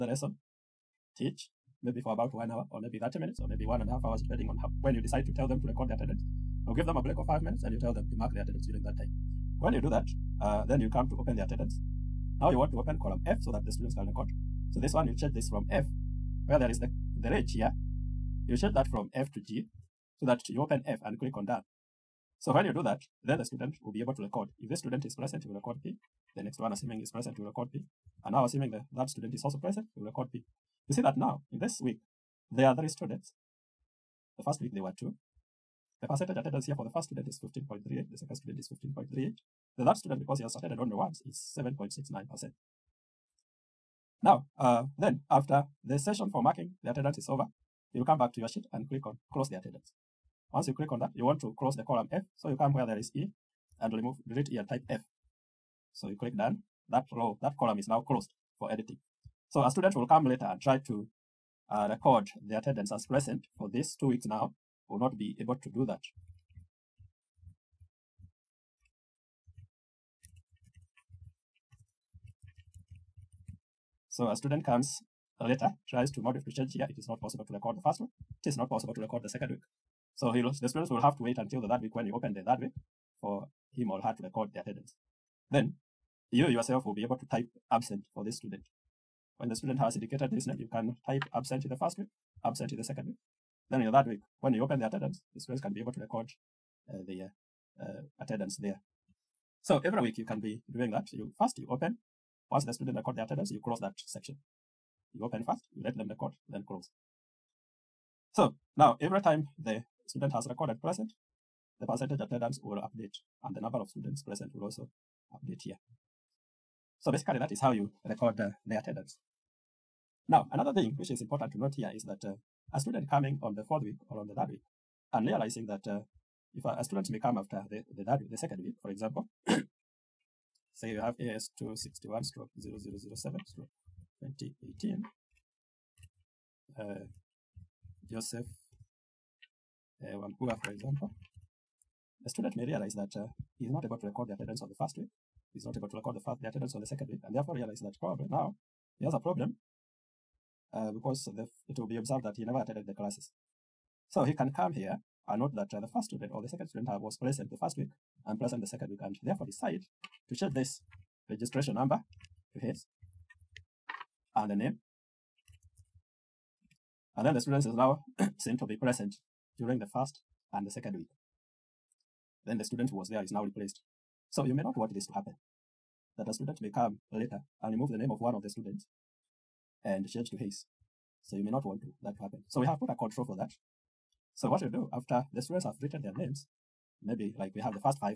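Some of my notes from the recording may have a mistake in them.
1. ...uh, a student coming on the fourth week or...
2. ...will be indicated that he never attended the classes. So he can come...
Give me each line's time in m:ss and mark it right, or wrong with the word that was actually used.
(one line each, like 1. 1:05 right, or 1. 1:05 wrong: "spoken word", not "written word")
1. 2:02 right
2. 2:31 wrong: "observed", not "indicated".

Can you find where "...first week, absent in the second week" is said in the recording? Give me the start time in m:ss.
1:31.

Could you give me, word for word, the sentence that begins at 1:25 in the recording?
Then you yourself will be able to type absent for this student.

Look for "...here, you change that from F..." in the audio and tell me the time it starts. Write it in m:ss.
0:17.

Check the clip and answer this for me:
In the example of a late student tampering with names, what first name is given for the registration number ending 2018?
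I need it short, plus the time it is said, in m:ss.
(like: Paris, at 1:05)
Joseph, at 2:18.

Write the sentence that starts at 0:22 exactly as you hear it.
So when you do that, then the student will be able to record.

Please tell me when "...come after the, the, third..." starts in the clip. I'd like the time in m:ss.
2:07.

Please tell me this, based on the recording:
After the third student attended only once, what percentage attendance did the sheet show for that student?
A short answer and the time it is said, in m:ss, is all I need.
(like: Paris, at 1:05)
7.69%, at 0:41.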